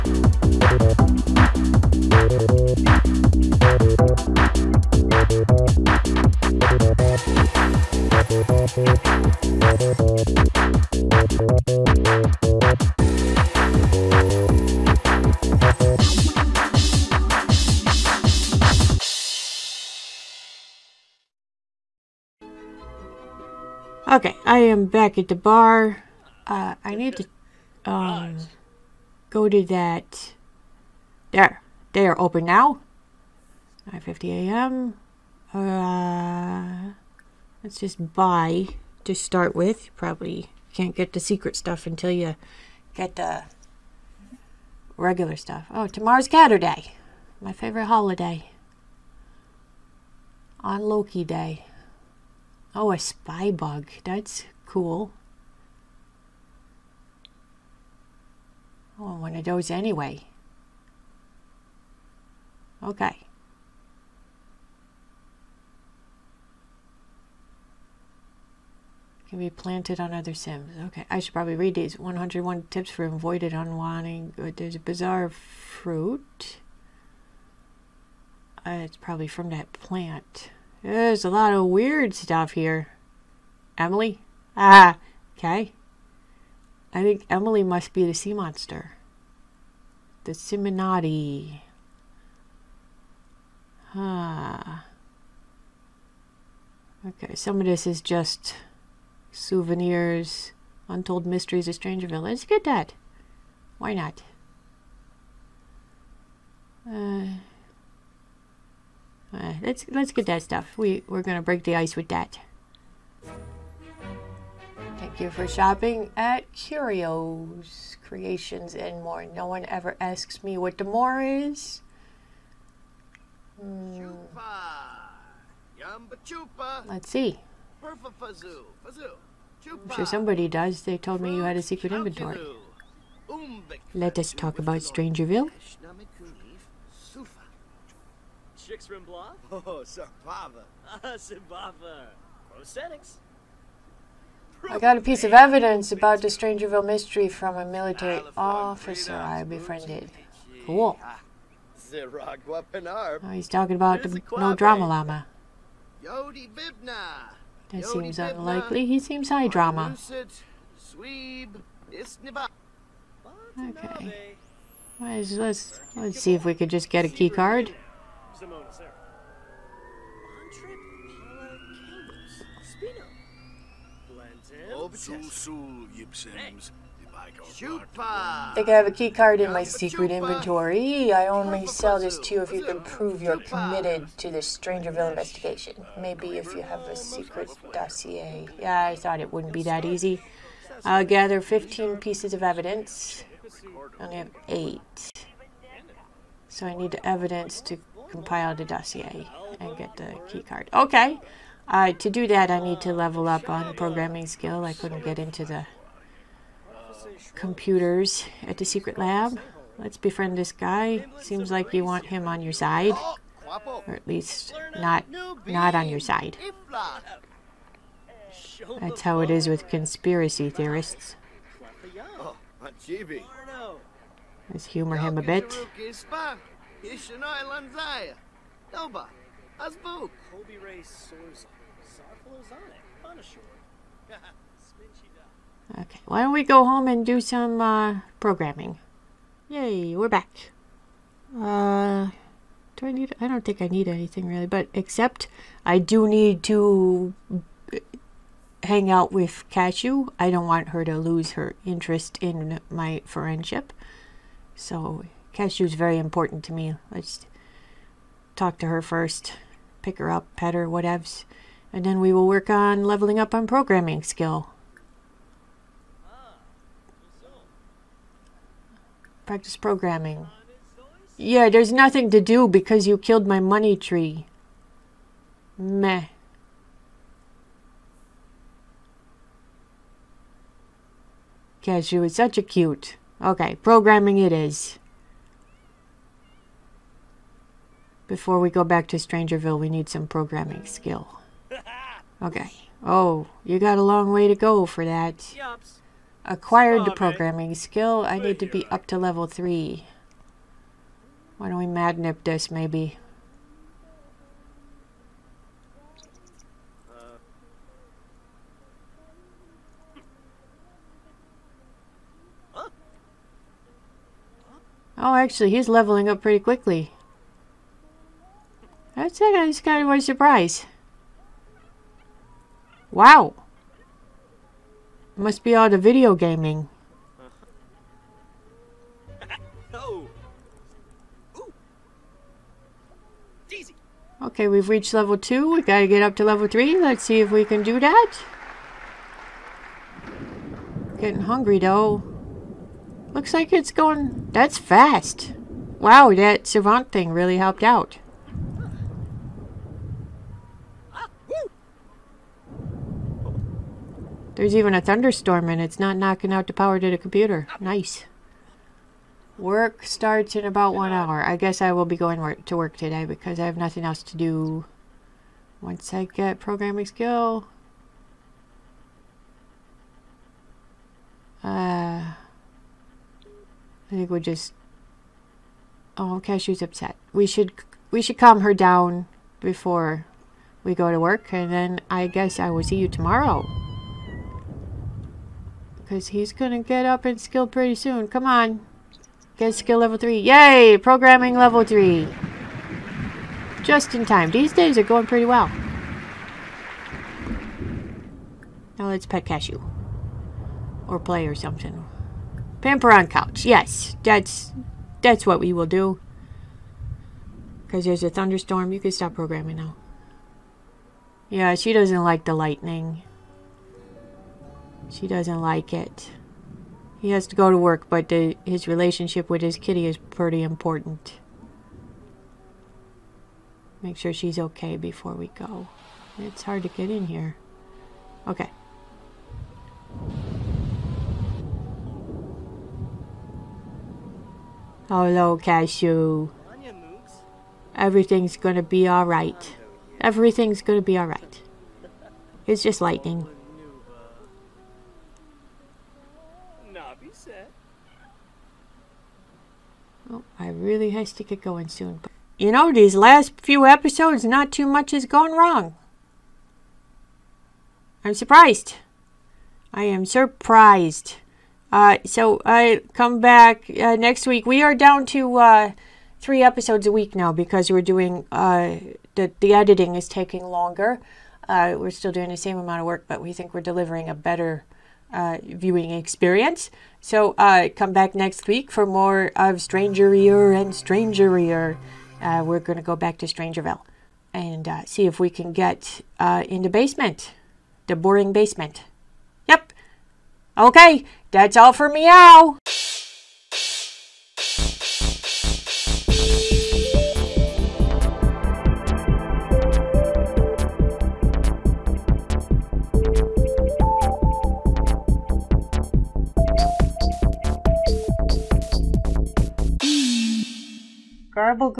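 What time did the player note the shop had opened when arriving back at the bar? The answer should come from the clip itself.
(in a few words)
9:50 a.m.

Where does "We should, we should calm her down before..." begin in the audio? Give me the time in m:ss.
6:17.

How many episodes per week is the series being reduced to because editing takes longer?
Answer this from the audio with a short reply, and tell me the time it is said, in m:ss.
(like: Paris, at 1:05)
3, at 7:46.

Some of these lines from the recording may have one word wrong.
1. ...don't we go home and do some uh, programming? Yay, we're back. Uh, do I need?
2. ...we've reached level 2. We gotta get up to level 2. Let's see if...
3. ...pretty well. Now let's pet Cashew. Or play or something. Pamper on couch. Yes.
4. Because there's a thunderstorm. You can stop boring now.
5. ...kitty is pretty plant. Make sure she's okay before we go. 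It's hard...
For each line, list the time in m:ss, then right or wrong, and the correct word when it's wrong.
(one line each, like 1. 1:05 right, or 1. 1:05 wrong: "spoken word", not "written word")
1. 3:56 right
2. 5:34 wrong: "3", not "2"
3. 6:35 right
4. 6:47 wrong: "programming", not "boring"
5. 6:59 wrong: "important", not "plant".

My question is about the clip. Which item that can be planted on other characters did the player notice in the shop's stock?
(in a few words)
A spy bug.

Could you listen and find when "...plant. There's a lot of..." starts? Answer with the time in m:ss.
1:19.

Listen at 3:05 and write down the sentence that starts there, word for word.
Maybe if you have a secret dossier.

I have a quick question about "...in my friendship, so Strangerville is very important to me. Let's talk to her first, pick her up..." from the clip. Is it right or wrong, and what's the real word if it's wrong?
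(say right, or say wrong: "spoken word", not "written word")
wrong: "Cashew", not "Strangerville".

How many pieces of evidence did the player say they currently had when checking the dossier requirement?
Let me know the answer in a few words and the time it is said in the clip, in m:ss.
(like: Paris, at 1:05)
8, at 3:14.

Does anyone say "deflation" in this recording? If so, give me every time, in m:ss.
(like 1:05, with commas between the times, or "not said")
not said.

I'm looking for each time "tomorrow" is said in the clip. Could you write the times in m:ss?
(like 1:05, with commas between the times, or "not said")
0:45, 6:22.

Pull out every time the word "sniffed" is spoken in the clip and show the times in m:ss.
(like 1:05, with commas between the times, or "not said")
not said.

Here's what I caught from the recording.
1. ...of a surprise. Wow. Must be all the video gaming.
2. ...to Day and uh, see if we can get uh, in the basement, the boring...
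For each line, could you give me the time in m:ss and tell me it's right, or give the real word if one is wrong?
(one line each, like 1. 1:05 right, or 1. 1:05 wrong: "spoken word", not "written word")
1. 5:19 right
2. 8:03 wrong: "Strangerville", not "Day".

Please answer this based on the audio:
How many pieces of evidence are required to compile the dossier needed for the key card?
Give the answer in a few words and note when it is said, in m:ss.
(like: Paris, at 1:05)
15, at 3:11.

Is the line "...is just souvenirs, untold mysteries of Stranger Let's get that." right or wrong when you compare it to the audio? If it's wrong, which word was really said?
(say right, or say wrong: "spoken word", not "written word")
right.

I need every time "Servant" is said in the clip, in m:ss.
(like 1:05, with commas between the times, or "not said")
5:46.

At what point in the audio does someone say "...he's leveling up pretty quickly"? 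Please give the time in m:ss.
5:15.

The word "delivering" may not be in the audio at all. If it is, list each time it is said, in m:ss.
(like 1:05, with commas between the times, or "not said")
7:53.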